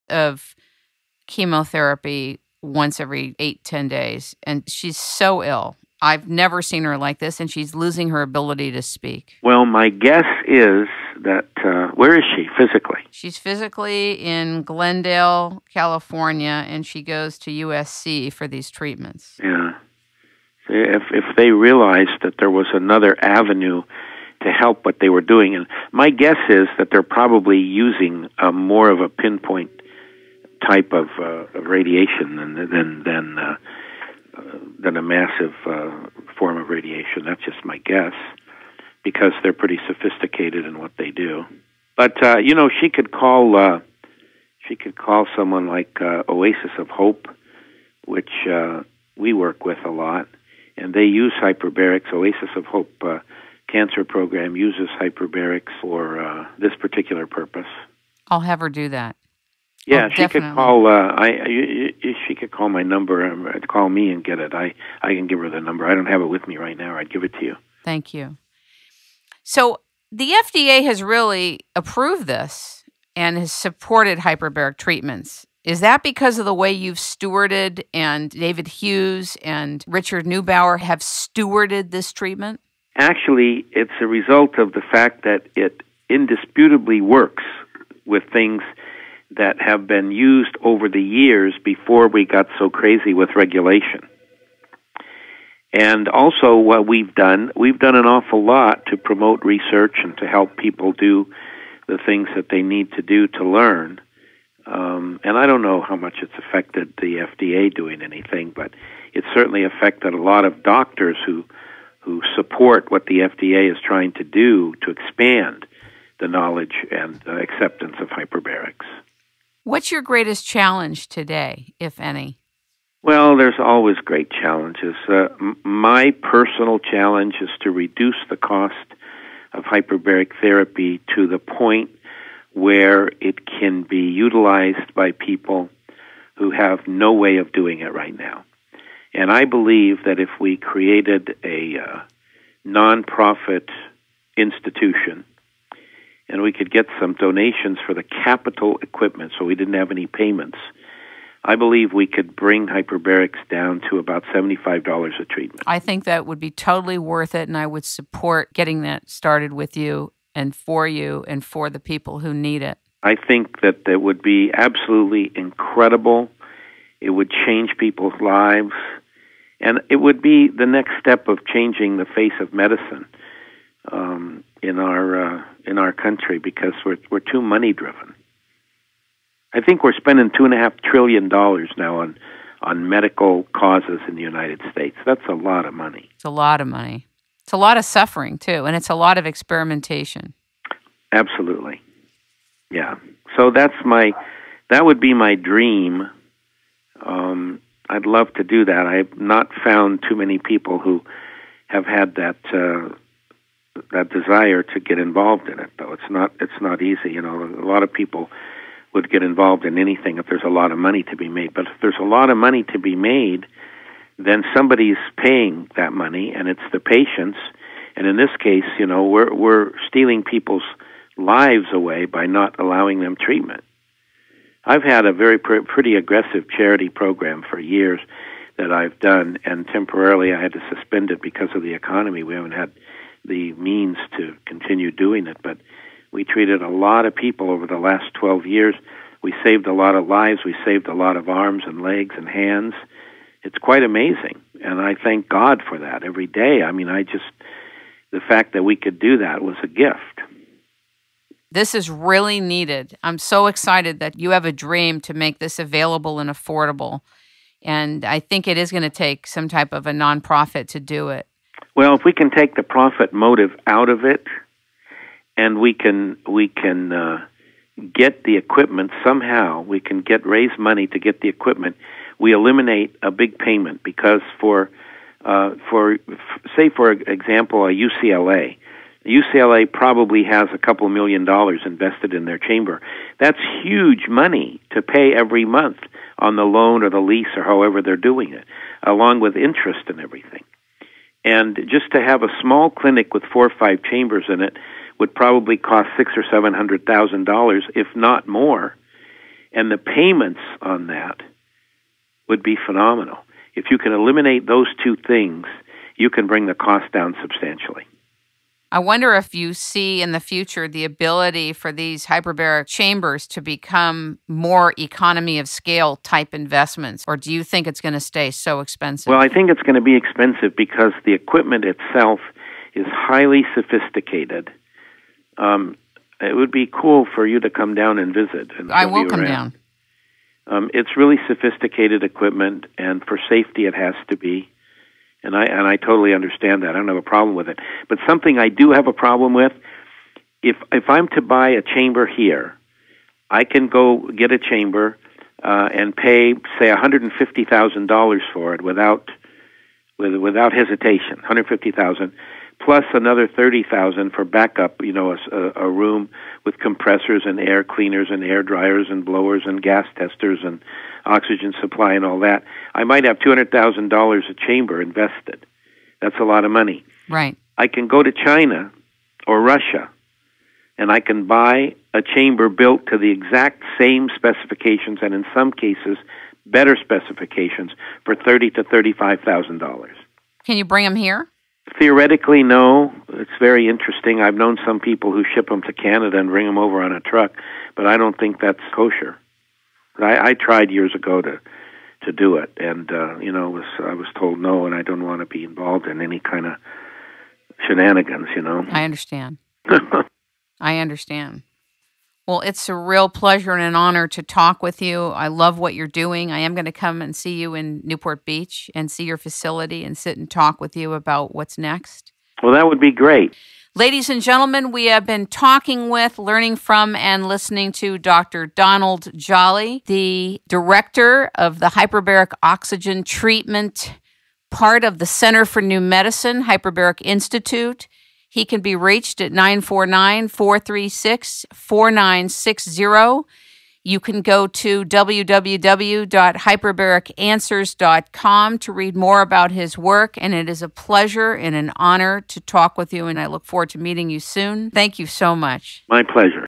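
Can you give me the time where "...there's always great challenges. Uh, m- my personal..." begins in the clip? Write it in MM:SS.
02:03.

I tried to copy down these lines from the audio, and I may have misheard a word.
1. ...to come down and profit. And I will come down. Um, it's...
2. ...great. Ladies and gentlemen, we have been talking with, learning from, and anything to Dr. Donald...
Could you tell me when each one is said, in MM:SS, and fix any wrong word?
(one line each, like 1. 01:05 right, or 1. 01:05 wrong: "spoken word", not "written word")
1. 05:27 wrong: "visit", not "profit"
2. 06:52 wrong: "listening", not "anything".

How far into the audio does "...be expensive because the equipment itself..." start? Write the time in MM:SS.
05:19.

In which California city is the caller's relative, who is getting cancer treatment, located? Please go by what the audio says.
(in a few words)
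Glendale.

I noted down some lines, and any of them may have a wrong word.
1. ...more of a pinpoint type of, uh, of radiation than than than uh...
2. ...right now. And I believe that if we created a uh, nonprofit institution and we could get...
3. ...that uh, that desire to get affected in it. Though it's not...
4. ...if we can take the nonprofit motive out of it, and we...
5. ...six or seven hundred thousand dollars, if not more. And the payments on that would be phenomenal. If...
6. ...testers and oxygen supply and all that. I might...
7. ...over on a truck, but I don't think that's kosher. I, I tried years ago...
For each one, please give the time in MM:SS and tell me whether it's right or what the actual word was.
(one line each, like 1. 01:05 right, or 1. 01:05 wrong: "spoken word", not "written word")
1. 00:28 right
2. 02:17 right
3. 03:22 wrong: "involved", not "affected"
4. 04:21 wrong: "profit", not "nonprofit"
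5. 04:55 right
6. 05:59 right
7. 06:26 right.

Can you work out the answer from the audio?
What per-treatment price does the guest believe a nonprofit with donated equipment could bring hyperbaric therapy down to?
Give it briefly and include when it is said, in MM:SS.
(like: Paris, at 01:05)
$75, at 02:34.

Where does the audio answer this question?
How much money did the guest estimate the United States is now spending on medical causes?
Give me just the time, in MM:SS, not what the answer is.
03:00.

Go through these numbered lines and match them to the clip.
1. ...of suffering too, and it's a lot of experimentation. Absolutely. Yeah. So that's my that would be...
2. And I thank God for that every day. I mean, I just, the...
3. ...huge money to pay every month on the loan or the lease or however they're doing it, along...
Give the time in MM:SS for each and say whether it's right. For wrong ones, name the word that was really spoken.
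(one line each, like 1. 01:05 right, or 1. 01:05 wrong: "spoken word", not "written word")
1. 03:07 right
2. 04:04 right
3. 04:43 right.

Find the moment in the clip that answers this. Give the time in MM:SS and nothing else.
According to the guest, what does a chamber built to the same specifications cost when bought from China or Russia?
06:18.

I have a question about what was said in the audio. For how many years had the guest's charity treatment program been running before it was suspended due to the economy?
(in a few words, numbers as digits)
12.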